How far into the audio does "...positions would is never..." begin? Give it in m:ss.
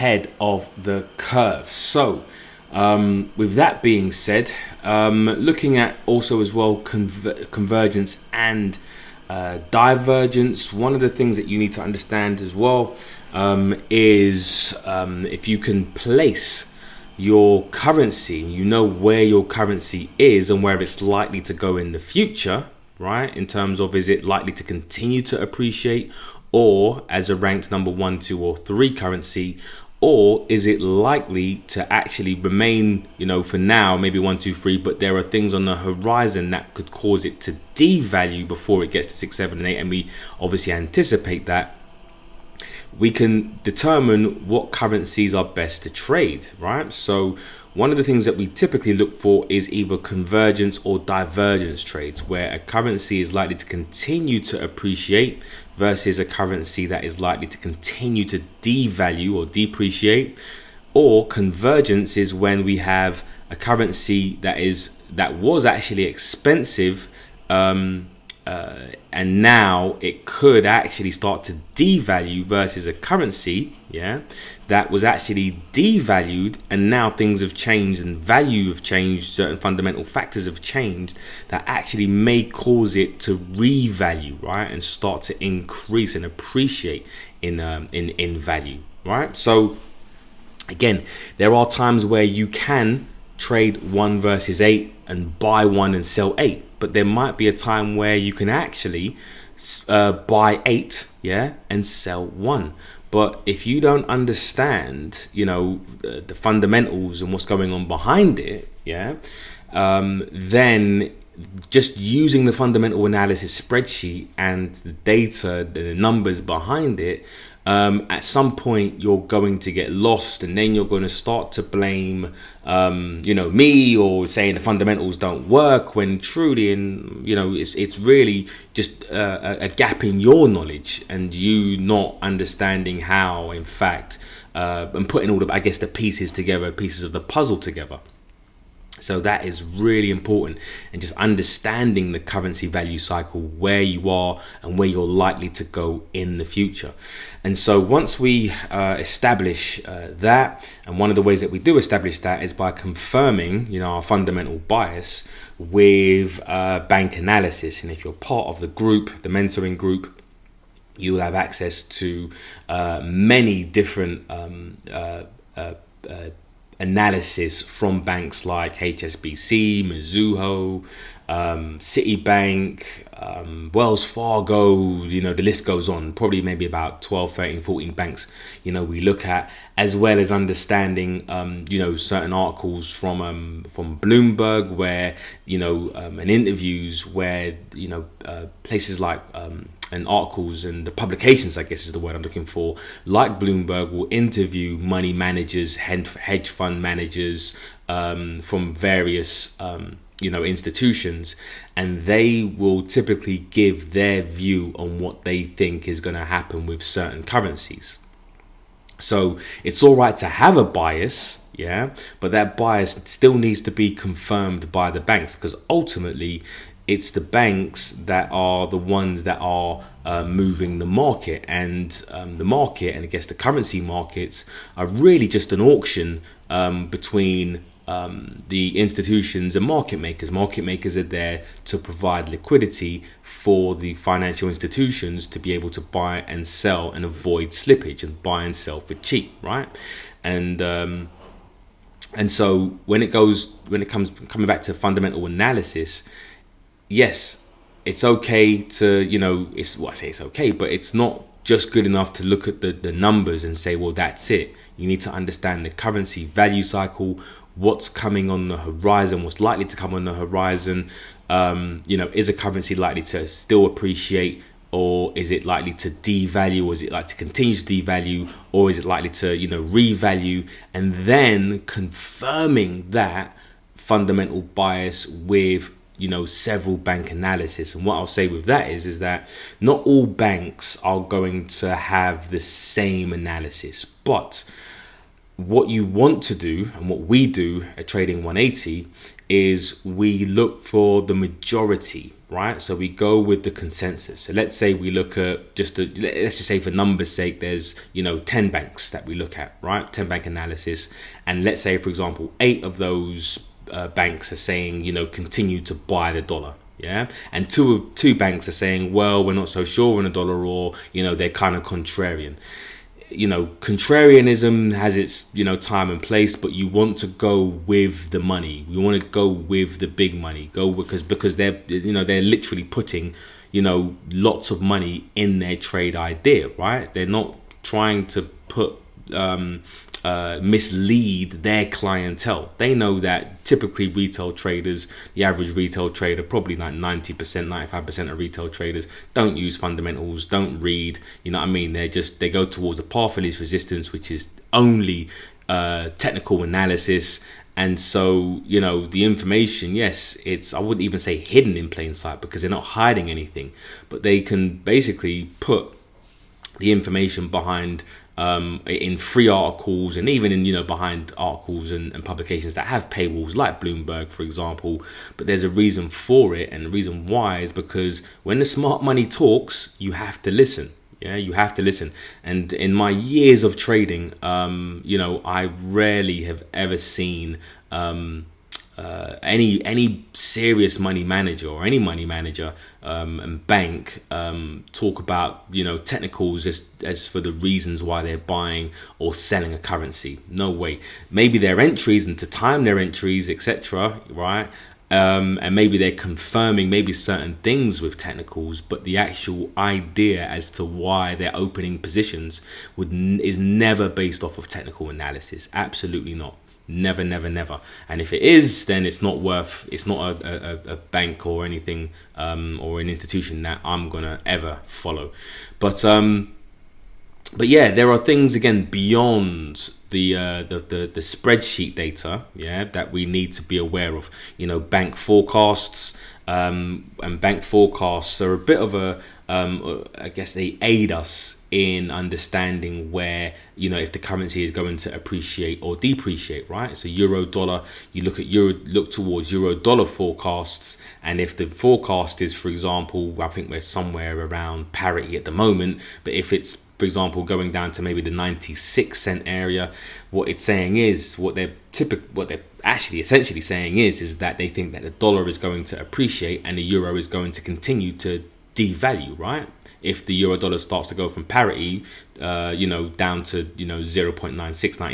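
6:41.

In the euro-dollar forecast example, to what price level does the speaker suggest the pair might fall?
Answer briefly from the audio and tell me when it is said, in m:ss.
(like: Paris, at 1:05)
96 cents, at 7:28.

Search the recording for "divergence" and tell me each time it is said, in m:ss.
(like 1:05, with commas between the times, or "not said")
0:09, 0:50.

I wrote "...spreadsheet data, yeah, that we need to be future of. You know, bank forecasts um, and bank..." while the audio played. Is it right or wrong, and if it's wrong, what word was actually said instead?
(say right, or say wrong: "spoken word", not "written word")
wrong: "aware", not "future".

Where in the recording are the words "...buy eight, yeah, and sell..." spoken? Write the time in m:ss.
1:40.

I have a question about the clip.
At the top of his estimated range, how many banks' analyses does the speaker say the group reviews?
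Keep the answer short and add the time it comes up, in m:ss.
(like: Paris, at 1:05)
14, at 2:57.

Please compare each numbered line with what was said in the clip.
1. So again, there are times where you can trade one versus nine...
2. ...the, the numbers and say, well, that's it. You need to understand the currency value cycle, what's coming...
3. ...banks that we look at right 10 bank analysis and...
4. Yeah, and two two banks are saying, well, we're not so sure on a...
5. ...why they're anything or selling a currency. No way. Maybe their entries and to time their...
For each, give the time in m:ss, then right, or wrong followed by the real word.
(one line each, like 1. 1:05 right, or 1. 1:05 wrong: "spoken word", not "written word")
1. 1:29 wrong: "eight", not "nine"
2. 4:12 right
3. 4:58 right
4. 5:06 right
5. 6:27 wrong: "buying", not "anything".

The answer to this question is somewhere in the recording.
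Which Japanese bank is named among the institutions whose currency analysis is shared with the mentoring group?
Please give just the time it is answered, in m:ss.
2:49.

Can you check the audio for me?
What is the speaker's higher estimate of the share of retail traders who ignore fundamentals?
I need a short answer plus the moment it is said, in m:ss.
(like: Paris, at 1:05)
95%, at 5:37.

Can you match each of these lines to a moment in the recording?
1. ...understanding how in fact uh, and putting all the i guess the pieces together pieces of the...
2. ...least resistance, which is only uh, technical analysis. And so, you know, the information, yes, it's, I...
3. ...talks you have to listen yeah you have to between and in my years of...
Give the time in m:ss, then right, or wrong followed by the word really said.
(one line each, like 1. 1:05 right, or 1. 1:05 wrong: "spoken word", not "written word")
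1. 2:12 right
2. 5:43 right
3. 6:09 wrong: "listen", not "between".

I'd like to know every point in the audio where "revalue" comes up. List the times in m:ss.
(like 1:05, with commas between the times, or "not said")
1:23, 4:29.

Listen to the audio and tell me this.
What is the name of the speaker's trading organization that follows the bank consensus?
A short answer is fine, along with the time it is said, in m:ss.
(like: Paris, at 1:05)
Trading 180, at 4:47.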